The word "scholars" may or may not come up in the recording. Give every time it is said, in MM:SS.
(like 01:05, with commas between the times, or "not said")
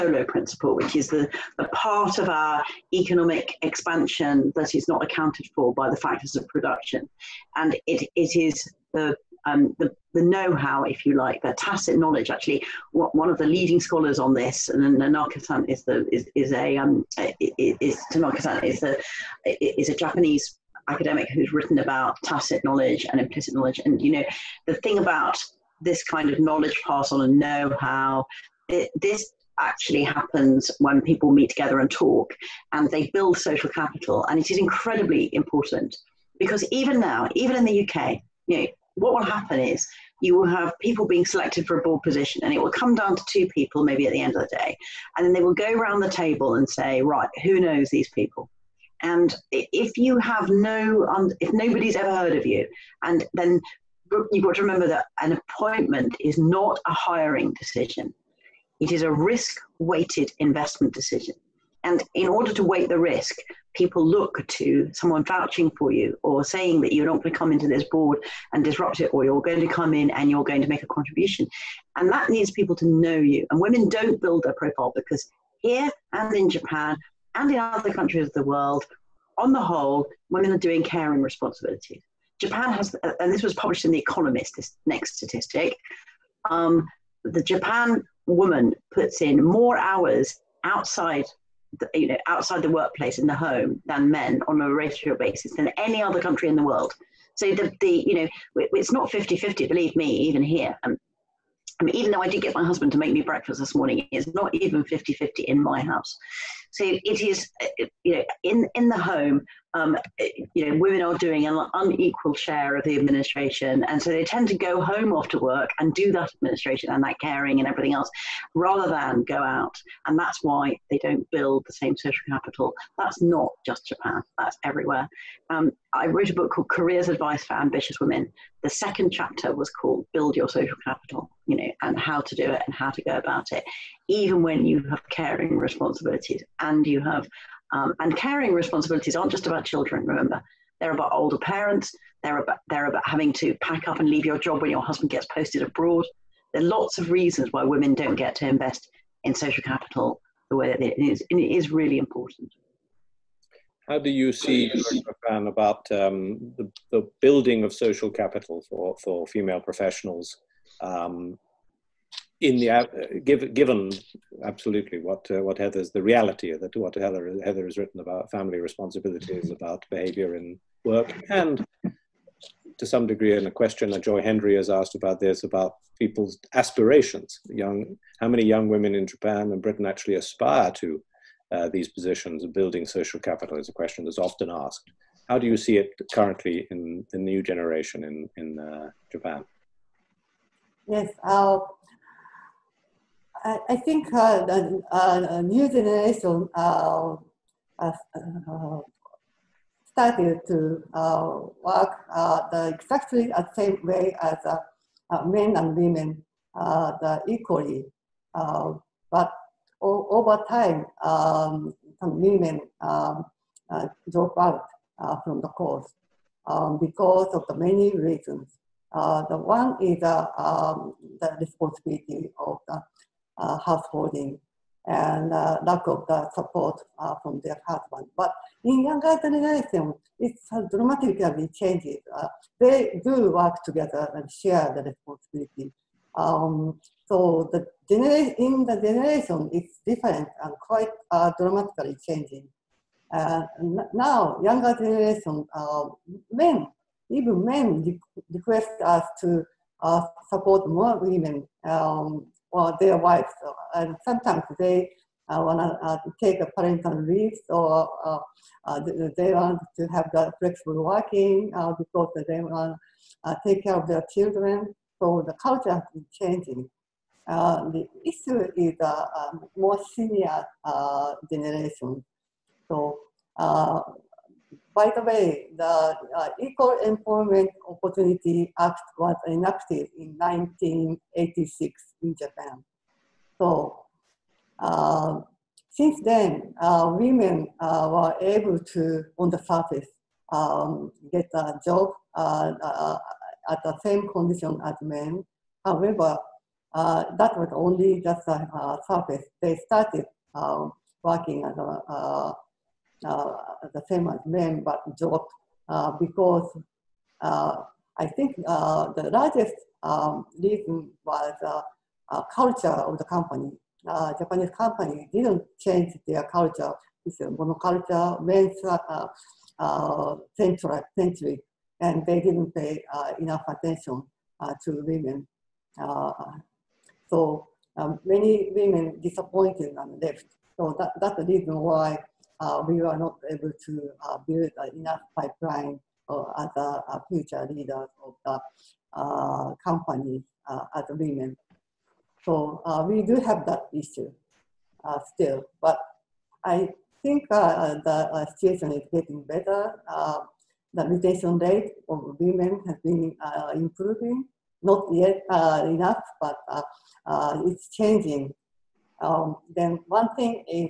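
00:13.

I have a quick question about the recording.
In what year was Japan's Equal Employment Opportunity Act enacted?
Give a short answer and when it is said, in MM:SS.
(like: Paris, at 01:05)
1986, at 04:40.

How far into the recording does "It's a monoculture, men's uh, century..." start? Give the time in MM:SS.
05:17.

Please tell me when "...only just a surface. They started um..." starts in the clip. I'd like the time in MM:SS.
04:57.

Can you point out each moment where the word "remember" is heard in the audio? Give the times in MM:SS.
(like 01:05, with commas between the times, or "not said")
00:54, 02:20.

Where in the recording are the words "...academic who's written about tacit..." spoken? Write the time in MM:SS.
00:20.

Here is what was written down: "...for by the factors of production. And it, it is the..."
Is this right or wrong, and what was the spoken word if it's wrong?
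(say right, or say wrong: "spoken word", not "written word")
right.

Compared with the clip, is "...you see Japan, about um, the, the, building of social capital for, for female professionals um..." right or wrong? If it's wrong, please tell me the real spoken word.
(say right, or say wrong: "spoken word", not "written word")
right.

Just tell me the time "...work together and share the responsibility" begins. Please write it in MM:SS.
03:53.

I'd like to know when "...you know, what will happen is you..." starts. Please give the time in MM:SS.
00:38.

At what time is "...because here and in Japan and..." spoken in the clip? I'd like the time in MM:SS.
01:14.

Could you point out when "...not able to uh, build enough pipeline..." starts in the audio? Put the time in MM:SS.
05:32.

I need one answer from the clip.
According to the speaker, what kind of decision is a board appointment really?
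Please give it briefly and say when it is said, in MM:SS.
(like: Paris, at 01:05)
A risk weighted investment decision, at 00:59.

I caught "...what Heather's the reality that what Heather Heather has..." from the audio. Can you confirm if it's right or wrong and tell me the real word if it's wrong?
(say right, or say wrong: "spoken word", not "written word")
right.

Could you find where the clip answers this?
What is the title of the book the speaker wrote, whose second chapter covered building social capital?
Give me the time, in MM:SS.
02:06.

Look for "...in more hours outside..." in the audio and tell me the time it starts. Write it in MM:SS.
01:29.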